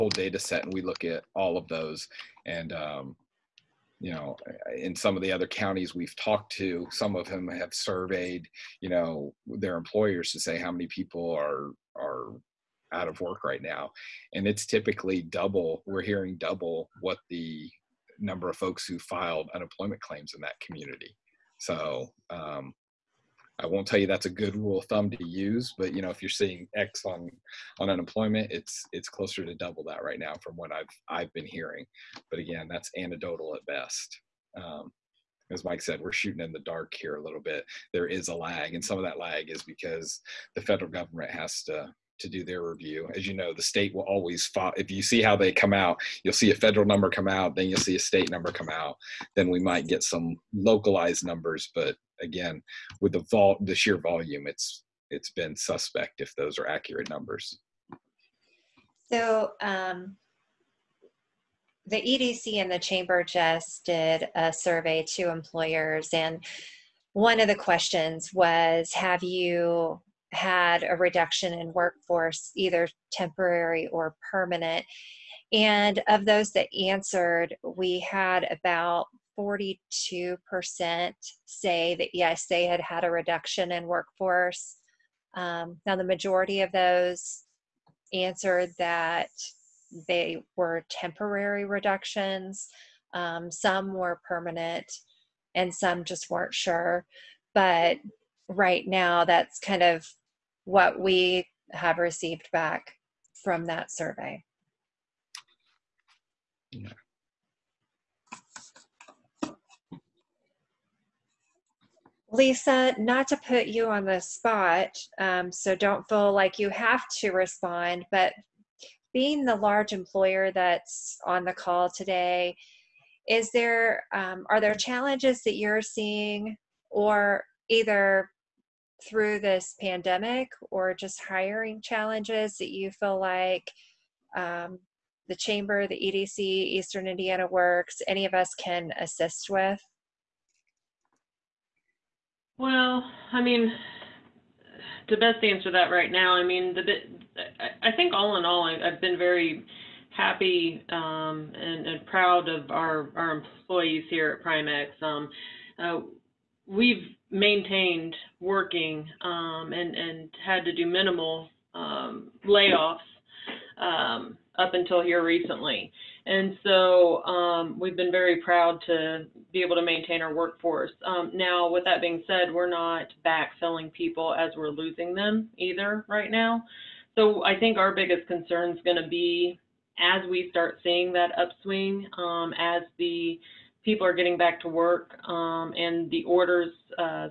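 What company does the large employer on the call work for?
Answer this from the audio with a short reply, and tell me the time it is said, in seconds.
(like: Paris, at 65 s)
Primex, at 154 s.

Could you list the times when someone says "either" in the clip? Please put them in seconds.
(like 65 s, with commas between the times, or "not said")
72 s, 127 s, 175 s.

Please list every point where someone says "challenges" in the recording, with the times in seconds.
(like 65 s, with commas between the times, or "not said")
124 s, 131 s.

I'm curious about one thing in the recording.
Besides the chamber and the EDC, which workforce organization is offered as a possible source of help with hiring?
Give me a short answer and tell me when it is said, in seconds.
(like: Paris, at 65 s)
Eastern Indiana Works, at 136 s.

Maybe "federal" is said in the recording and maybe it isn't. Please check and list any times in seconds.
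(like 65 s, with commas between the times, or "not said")
40 s, 46 s.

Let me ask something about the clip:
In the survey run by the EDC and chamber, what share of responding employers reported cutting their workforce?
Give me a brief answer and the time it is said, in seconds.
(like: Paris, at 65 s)
42%, at 79 s.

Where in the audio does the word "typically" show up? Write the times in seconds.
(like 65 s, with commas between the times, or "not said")
14 s.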